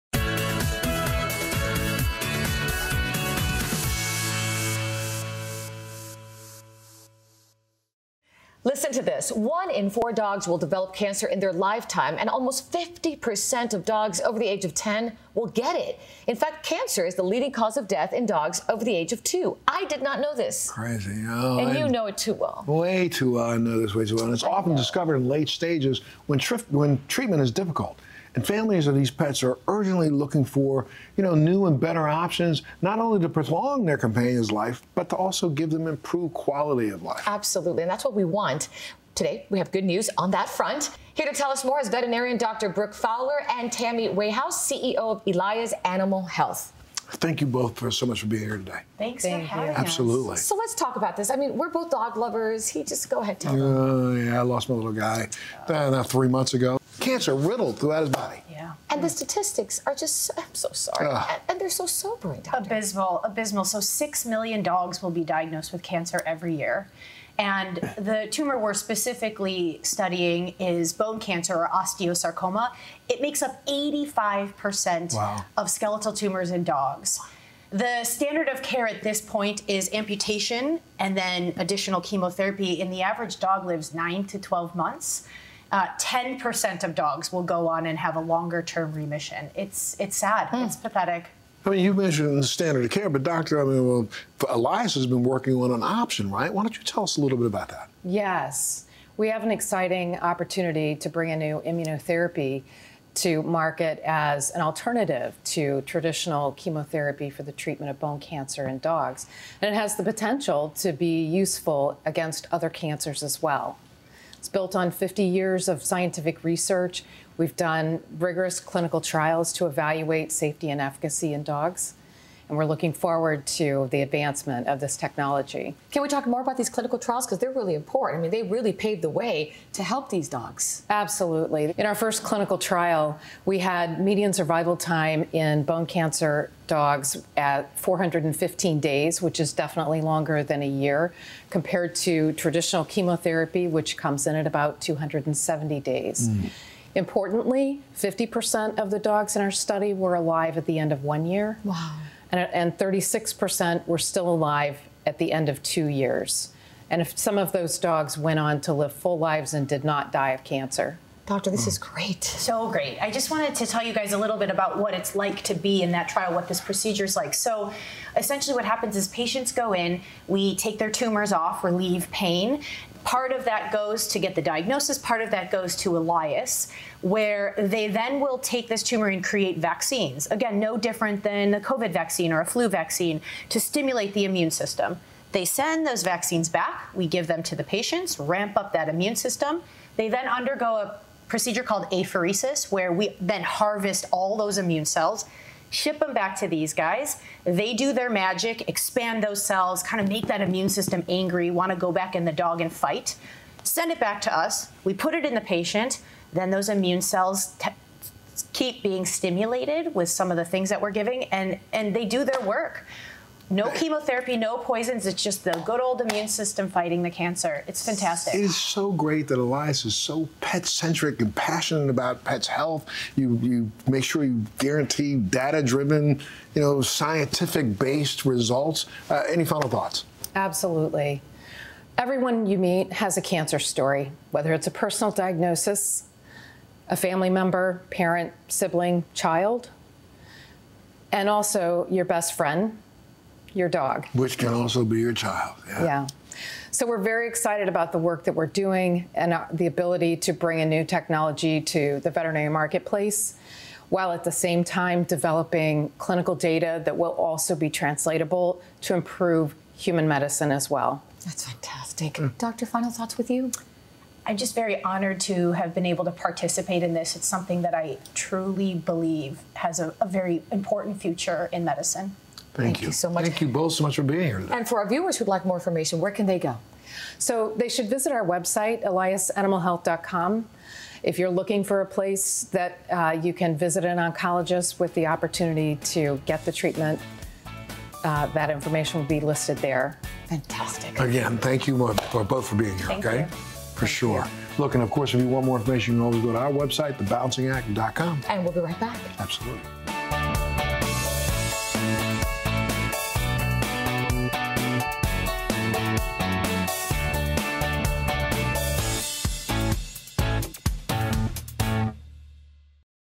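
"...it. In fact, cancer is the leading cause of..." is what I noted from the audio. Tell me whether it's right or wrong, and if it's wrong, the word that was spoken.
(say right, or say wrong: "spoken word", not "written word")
right.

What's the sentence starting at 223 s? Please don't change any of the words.
You you make sure you guarantee data driven, you know, scientific based results.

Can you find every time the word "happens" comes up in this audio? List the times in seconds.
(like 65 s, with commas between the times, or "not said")
168 s.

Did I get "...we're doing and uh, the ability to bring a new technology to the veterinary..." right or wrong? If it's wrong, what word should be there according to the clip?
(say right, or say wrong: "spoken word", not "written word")
right.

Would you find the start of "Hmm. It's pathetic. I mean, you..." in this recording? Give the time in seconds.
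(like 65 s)
90 s.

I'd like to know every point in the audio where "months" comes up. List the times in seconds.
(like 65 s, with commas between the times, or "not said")
56 s, 84 s.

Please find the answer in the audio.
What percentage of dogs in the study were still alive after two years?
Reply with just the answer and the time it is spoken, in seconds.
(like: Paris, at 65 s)
36%, at 152 s.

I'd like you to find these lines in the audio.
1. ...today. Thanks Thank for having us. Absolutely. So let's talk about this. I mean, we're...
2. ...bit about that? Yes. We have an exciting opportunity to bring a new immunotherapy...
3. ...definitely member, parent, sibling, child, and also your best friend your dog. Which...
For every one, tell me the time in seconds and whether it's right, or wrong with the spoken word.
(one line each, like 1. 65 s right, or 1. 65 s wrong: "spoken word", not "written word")
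1. 48 s right
2. 97 s right
3. 236 s wrong: "family", not "definitely".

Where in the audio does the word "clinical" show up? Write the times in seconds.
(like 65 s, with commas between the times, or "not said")
118 s, 126 s, 132 s, 255 s.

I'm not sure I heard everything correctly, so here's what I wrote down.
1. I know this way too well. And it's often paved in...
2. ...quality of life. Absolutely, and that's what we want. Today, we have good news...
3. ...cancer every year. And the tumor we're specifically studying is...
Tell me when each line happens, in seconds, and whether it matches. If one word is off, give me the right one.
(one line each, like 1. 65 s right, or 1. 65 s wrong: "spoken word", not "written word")
1. 23 s wrong: "discovered", not "paved"
2. 36 s right
3. 65 s right.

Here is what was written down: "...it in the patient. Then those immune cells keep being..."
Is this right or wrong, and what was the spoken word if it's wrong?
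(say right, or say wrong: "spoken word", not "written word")
right.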